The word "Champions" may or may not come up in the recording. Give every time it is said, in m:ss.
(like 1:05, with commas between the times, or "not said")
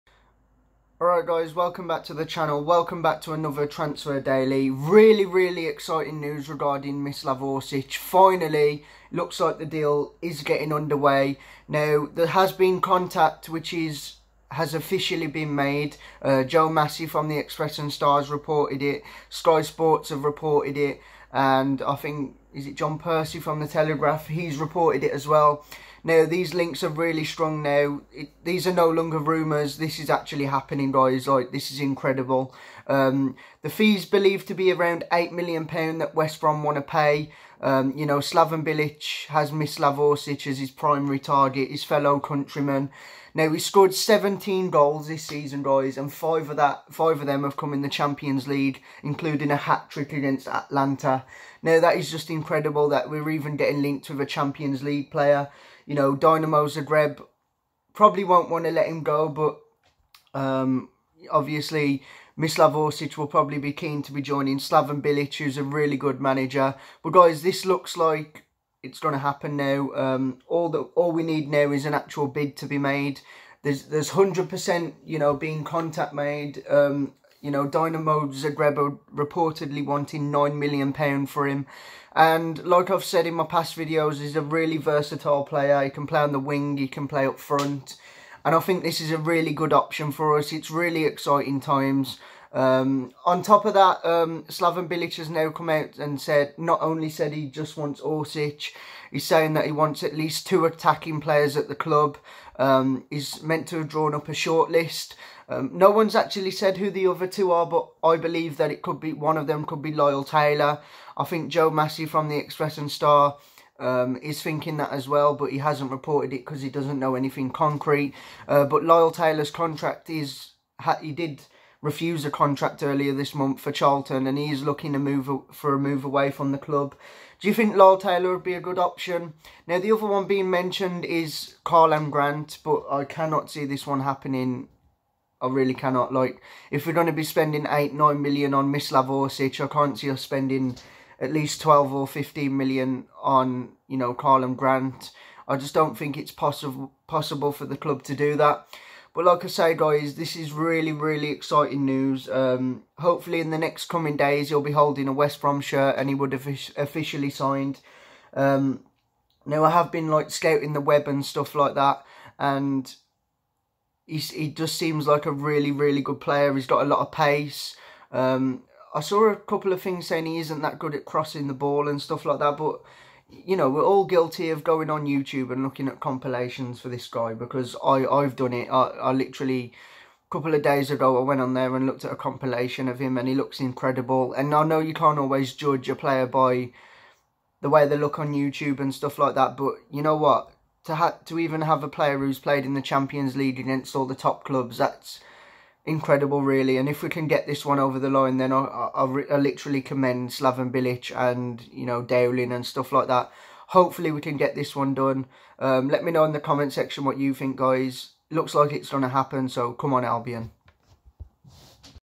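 0:47, 0:54, 3:12.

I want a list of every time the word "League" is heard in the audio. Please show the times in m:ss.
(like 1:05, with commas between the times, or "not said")
0:48, 0:54, 3:13.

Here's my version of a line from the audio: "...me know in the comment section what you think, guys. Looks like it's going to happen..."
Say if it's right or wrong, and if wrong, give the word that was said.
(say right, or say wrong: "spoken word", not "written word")
right.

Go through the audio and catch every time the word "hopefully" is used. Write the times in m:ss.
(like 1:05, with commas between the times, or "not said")
2:32, 3:23.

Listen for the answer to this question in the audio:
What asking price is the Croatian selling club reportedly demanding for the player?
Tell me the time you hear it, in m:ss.
1:20.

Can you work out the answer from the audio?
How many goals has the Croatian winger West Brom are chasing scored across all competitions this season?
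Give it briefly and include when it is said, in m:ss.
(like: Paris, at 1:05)
17, at 0:43.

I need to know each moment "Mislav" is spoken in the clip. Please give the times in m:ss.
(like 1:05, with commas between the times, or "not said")
0:07, 1:02, 2:18.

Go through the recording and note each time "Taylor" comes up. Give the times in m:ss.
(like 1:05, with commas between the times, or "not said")
1:50, 1:59, 2:07.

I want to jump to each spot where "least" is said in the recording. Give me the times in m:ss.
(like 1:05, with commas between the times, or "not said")
1:40, 2:21.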